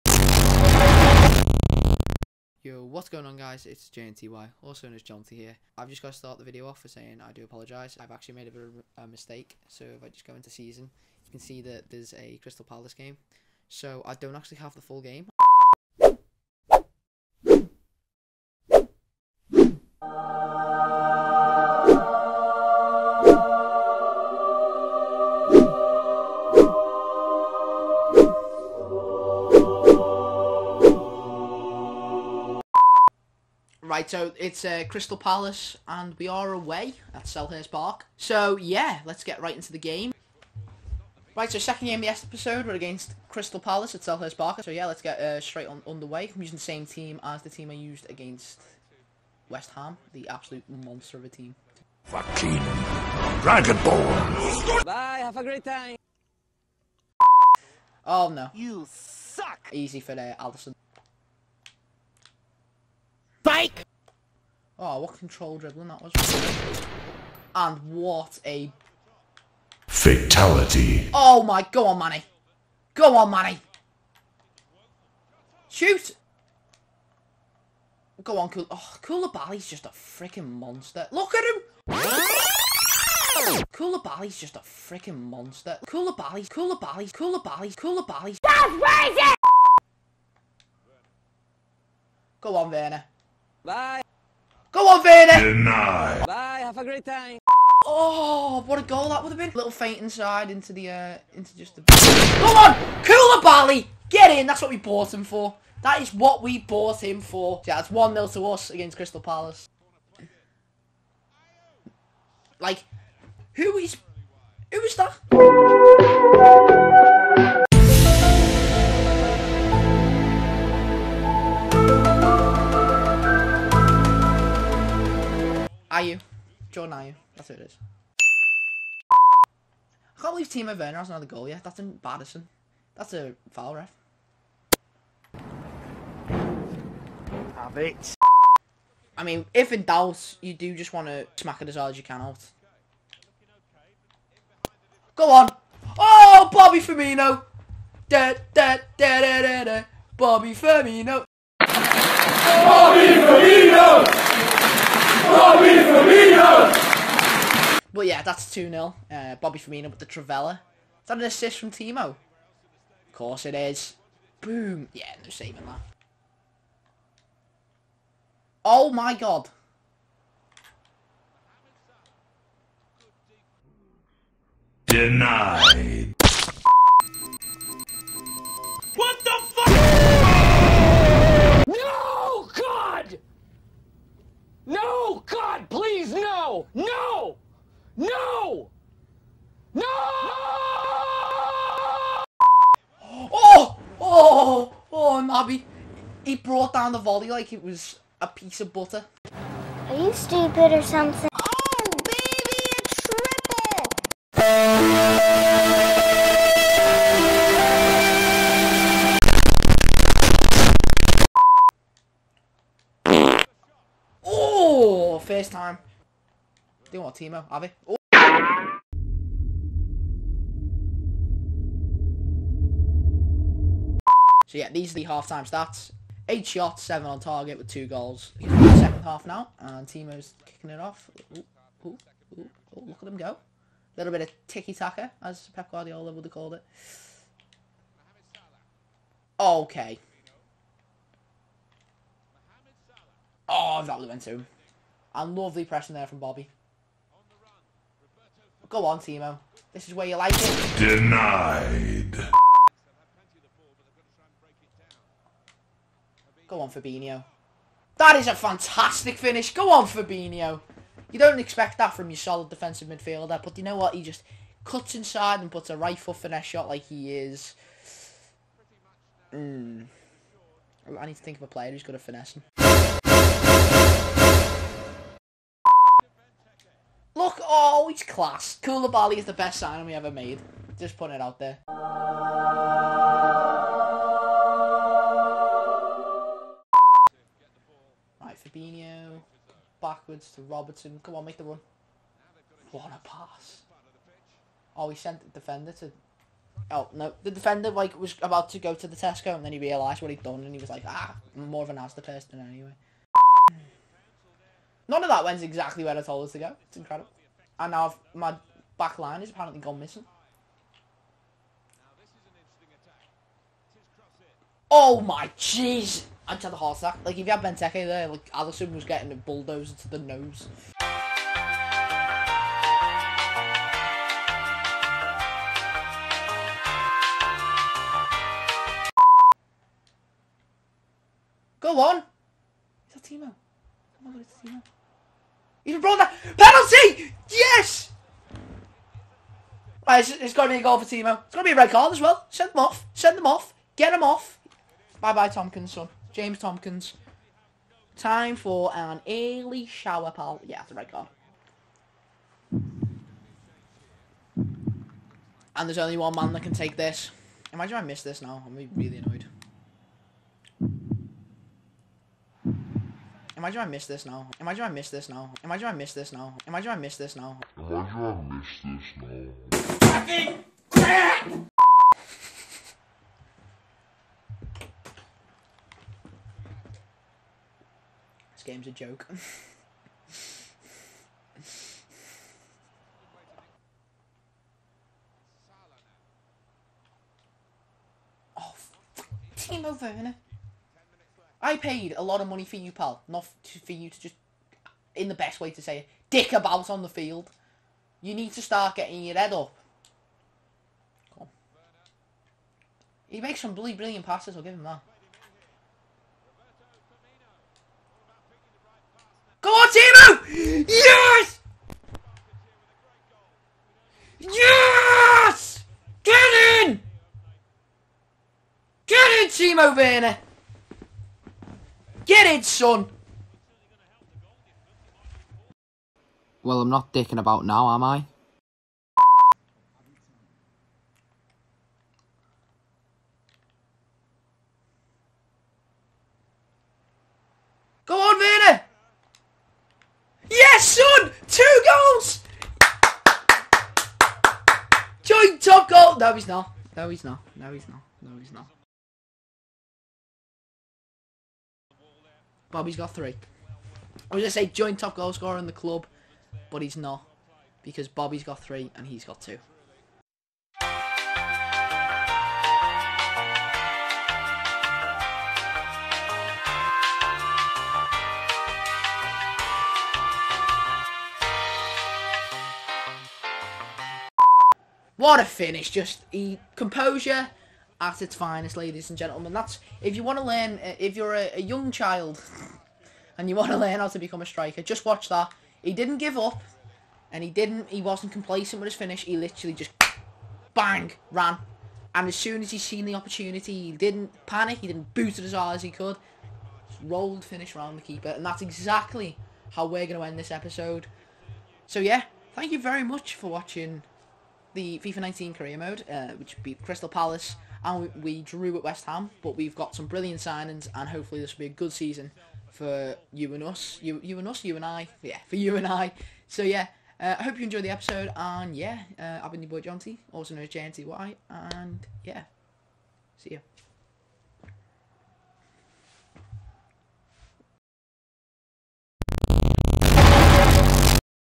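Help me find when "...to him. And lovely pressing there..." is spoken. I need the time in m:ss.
4:04.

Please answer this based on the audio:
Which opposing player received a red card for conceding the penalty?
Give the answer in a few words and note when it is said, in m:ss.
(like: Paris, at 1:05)
James Tomkins, at 5:46.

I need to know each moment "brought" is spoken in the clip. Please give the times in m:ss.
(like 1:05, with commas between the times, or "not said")
3:16, 5:35.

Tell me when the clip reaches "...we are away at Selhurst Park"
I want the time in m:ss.
0:36.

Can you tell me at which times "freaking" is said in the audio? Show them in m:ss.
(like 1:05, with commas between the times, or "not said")
1:19, 1:24.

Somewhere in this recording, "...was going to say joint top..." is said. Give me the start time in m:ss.
7:34.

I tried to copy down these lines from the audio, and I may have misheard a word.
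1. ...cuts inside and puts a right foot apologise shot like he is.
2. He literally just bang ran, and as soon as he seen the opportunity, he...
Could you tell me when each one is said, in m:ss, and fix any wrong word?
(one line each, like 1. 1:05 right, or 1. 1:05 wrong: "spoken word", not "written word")
1. 4:24 wrong: "finesse", not "apologise"
2. 8:09 right.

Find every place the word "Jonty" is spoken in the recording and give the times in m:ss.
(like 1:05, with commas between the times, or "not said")
0:05, 8:39.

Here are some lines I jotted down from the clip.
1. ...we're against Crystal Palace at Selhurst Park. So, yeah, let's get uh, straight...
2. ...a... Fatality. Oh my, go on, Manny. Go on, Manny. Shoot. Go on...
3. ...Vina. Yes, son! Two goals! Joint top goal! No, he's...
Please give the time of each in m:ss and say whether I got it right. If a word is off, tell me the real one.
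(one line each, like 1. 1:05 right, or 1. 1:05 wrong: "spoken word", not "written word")
1. 0:42 right
2. 1:08 right
3. 7:18 right.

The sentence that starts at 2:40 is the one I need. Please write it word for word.
Is that an assist from Timo?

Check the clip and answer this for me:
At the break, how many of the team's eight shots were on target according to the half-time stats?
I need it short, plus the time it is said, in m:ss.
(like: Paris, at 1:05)
7, at 3:46.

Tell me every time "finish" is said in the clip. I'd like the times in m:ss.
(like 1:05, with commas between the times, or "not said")
4:19, 7:55, 8:08, 8:17.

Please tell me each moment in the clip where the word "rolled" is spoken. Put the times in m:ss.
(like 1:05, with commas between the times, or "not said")
8:16.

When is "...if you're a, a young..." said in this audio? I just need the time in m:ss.
8:00.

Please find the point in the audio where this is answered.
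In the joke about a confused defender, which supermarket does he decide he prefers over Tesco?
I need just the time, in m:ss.
5:01.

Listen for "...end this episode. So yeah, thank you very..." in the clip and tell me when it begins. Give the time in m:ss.
8:20.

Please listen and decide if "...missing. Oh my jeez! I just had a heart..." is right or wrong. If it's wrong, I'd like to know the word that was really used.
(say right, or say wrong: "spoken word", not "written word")
right.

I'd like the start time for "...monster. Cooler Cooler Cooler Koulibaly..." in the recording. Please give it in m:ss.
1:25.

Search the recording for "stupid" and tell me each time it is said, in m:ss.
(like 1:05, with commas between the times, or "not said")
3:20.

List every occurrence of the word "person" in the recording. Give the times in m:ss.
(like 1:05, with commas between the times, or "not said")
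5:02.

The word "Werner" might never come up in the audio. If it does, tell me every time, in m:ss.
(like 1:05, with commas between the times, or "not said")
1:32, 2:10, 6:29, 6:59.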